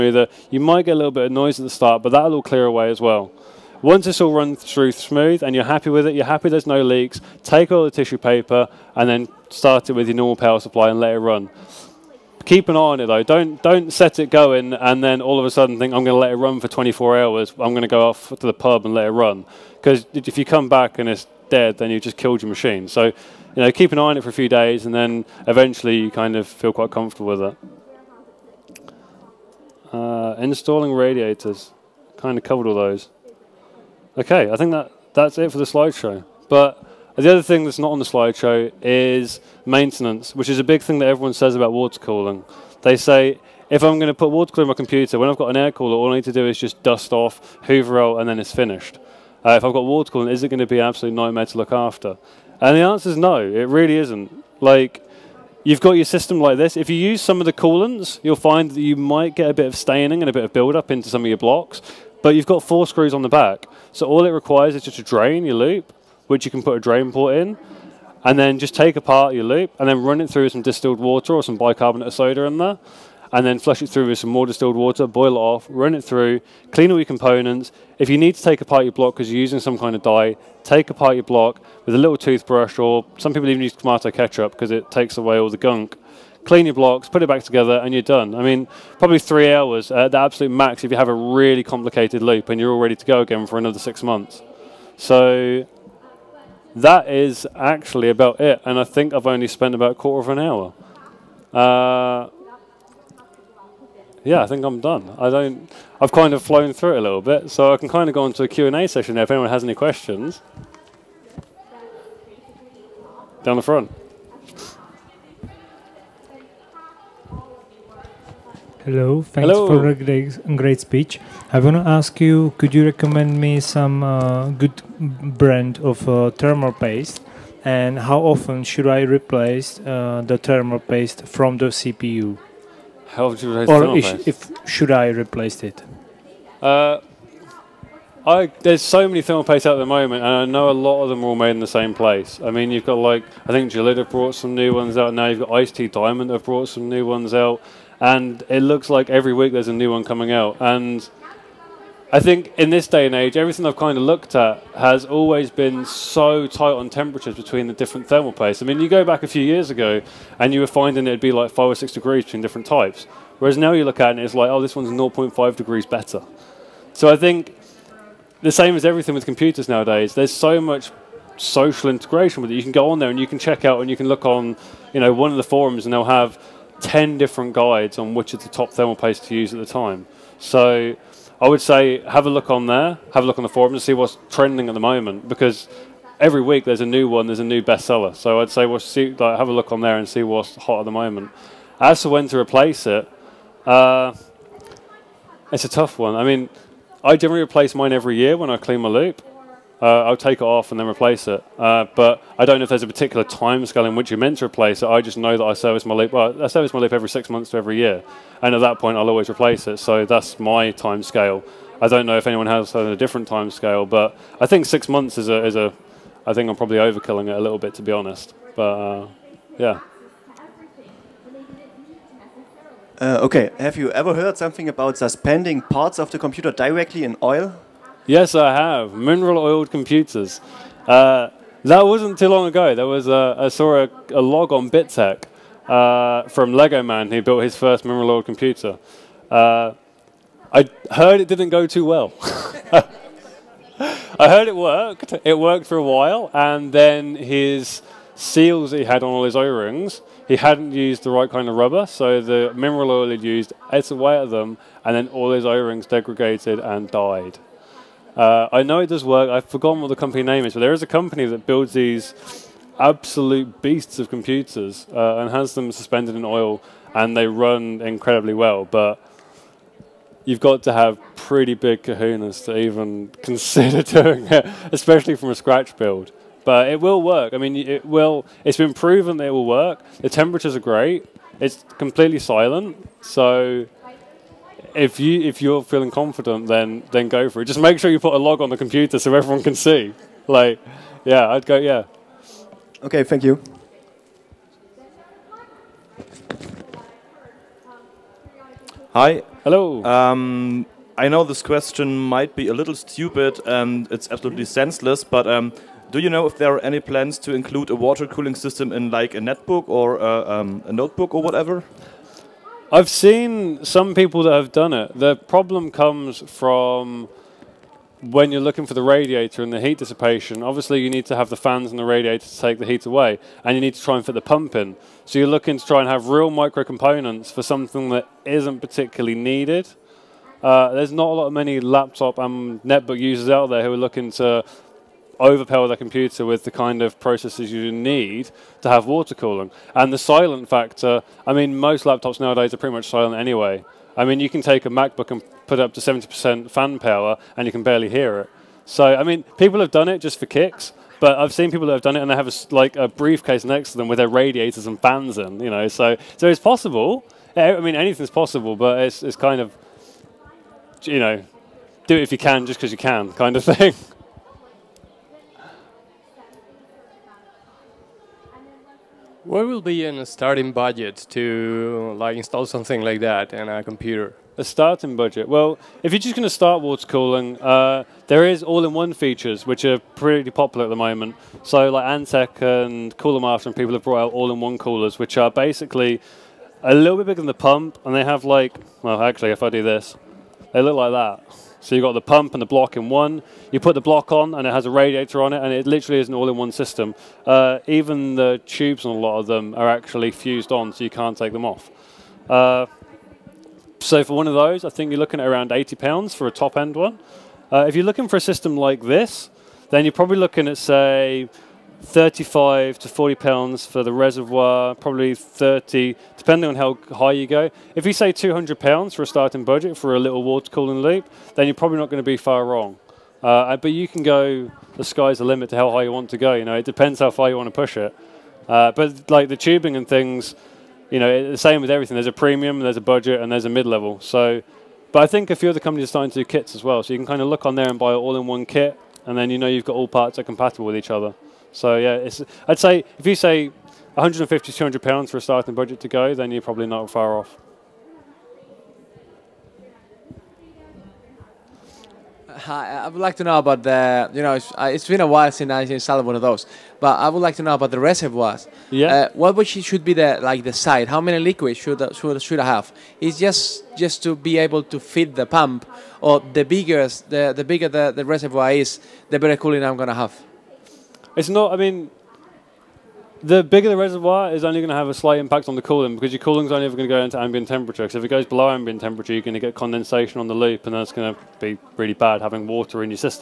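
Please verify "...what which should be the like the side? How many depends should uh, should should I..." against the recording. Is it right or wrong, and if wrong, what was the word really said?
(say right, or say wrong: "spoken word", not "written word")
wrong: "liquids", not "depends".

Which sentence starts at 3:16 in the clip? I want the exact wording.
I mean, I generally replace mine every year when I clean my loop uh, I'll take it off and then replace it.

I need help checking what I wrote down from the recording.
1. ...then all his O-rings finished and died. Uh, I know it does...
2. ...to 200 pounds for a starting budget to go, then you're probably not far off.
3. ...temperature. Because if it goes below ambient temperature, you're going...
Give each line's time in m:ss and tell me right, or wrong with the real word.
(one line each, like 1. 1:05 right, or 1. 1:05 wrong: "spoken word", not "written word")
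1. 4:14 wrong: "degraded", not "finished"
2. 7:24 right
3. 7:57 right.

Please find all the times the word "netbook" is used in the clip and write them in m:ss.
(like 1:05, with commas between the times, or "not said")
5:09, 5:32.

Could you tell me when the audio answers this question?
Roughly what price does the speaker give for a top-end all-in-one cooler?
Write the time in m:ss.
6:45.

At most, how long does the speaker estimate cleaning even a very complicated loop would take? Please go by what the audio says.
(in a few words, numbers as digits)
3 hours.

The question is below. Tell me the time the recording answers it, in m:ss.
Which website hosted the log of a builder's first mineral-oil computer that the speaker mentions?
3:54.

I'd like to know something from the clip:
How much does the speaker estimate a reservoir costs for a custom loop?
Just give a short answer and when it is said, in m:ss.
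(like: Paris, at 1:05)
35 to 40 pounds, at 6:51.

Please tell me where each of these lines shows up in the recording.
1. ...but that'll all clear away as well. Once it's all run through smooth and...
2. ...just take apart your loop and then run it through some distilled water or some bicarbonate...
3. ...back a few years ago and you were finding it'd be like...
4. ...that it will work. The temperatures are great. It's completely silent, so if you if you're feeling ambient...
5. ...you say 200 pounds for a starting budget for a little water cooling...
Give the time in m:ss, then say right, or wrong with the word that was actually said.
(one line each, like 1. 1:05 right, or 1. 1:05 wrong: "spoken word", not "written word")
1. 0:02 right
2. 1:08 right
3. 2:39 right
4. 4:39 wrong: "confident", not "ambient"
5. 6:57 right.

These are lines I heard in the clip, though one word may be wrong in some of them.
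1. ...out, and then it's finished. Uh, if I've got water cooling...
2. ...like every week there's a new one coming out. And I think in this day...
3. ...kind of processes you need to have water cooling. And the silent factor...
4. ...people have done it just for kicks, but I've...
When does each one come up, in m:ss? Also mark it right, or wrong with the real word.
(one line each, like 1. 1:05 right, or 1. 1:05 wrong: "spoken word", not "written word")
1. 0:48 right
2. 2:28 right
3. 5:36 right
4. 5:49 right.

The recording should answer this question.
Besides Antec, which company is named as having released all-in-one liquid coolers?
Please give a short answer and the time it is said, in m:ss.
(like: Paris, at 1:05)
Cooler Master, at 6:22.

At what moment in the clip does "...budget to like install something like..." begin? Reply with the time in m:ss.
6:10.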